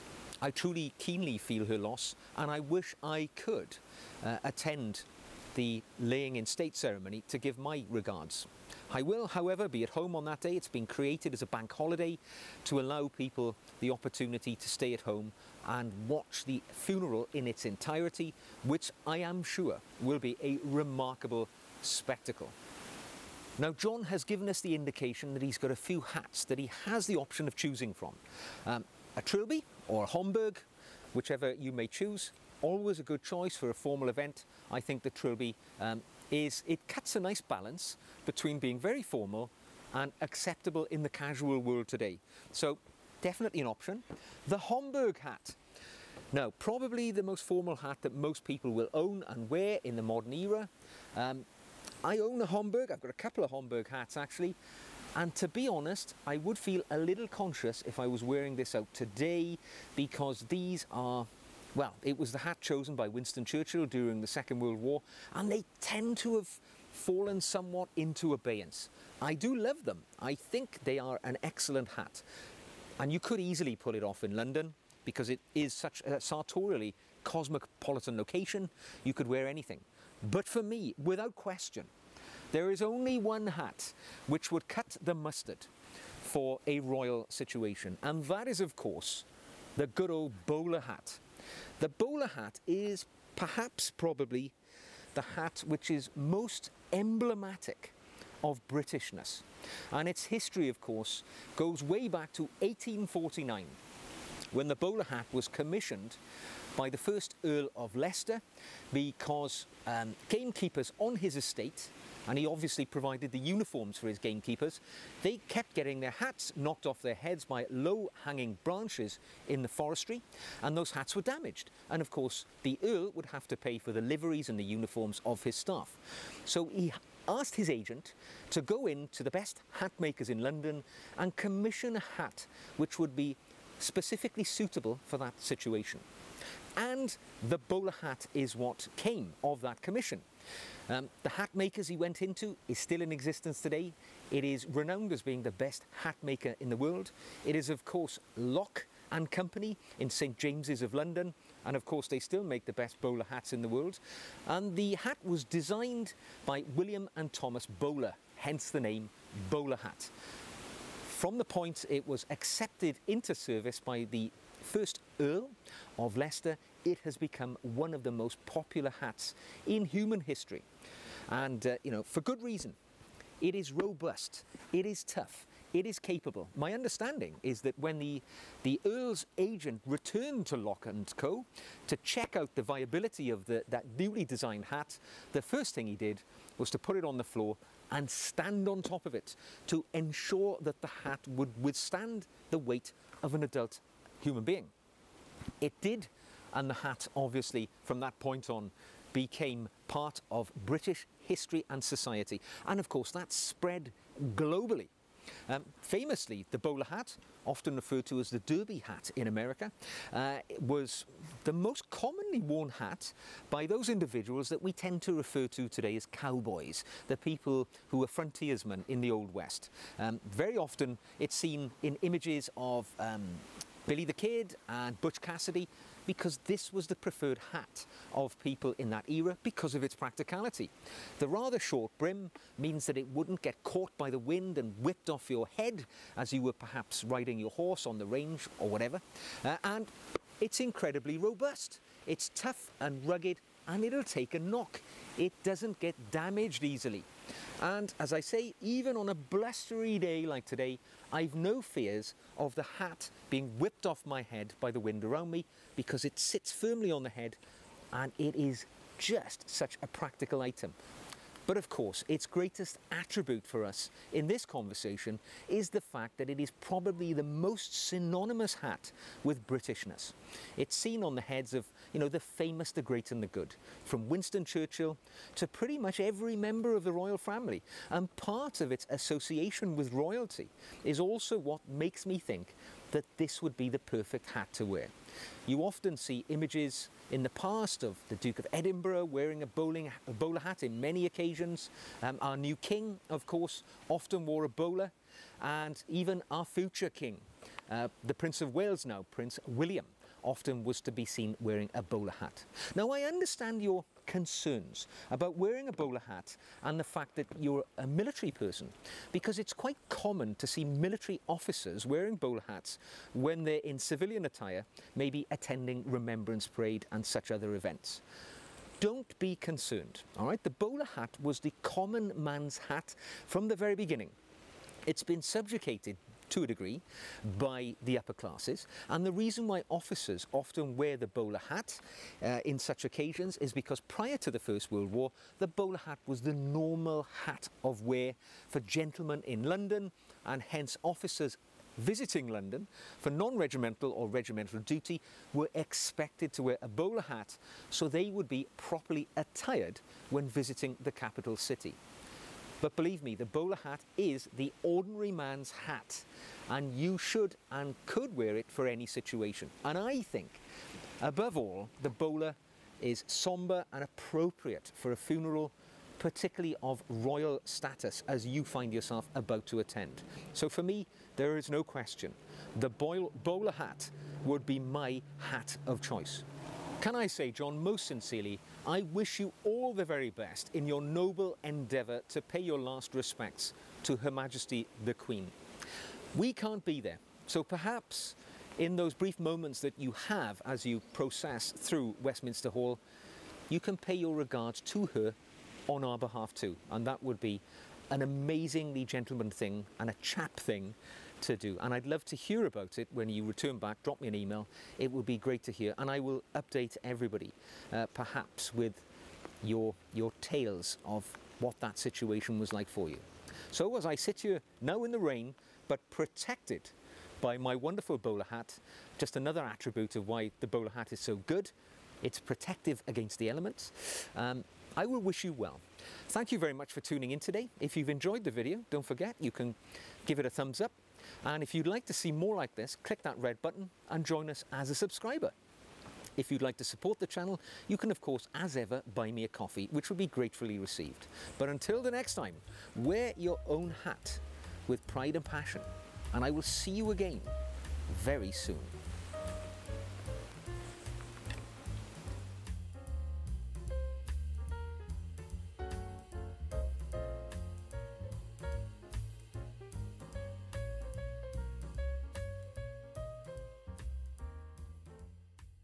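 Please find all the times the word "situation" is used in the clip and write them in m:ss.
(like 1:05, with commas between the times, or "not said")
1:27, 2:15, 5:58, 6:51.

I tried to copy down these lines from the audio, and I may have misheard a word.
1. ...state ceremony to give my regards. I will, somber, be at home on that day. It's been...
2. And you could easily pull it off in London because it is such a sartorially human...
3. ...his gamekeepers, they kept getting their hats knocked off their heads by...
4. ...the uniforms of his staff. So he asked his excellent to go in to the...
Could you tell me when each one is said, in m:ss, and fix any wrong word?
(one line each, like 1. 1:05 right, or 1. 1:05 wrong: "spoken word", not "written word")
1. 0:06 wrong: "however", not "somber"
2. 1:12 wrong: "cosmopolitan", not "human"
3. 1:54 right
4. 2:04 wrong: "agent", not "excellent".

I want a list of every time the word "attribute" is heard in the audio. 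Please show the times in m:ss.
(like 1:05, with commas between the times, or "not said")
4:22, 6:59.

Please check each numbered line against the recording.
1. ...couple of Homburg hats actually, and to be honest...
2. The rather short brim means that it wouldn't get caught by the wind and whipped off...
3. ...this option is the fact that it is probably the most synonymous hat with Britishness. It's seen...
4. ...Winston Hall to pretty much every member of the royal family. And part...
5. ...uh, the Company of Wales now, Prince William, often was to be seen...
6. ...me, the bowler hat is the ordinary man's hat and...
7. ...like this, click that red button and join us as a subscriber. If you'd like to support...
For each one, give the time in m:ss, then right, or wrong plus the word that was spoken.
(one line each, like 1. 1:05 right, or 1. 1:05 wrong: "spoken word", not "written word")
1. 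0:53 right
2. 3:51 right
3. 4:24 wrong: "conversation", not "option"
4. 4:34 wrong: "Churchill", not "Hall"
5. 4:57 wrong: "Prince", not "Company"
6. 5:53 right
7. 7:12 right.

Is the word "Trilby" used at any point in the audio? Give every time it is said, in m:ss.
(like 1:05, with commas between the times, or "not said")
0:29, 0:35.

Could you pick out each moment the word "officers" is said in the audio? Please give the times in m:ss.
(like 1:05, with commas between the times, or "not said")
5:11, 5:29, 5:40.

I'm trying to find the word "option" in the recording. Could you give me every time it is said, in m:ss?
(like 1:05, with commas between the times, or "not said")
0:27, 0:43.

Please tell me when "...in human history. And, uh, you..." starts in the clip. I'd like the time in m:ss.
2:49.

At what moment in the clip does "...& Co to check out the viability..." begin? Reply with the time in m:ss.
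3:00.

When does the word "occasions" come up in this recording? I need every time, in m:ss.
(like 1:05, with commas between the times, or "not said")
4:51, 5:32.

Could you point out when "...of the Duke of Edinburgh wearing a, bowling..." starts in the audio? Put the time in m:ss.
4:47.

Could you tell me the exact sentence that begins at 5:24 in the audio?
It's been subjugated to a degree, by the upper classes.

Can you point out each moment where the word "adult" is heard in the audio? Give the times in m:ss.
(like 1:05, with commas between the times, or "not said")
3:13.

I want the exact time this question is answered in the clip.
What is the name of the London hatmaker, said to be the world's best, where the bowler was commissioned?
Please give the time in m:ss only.
2:28.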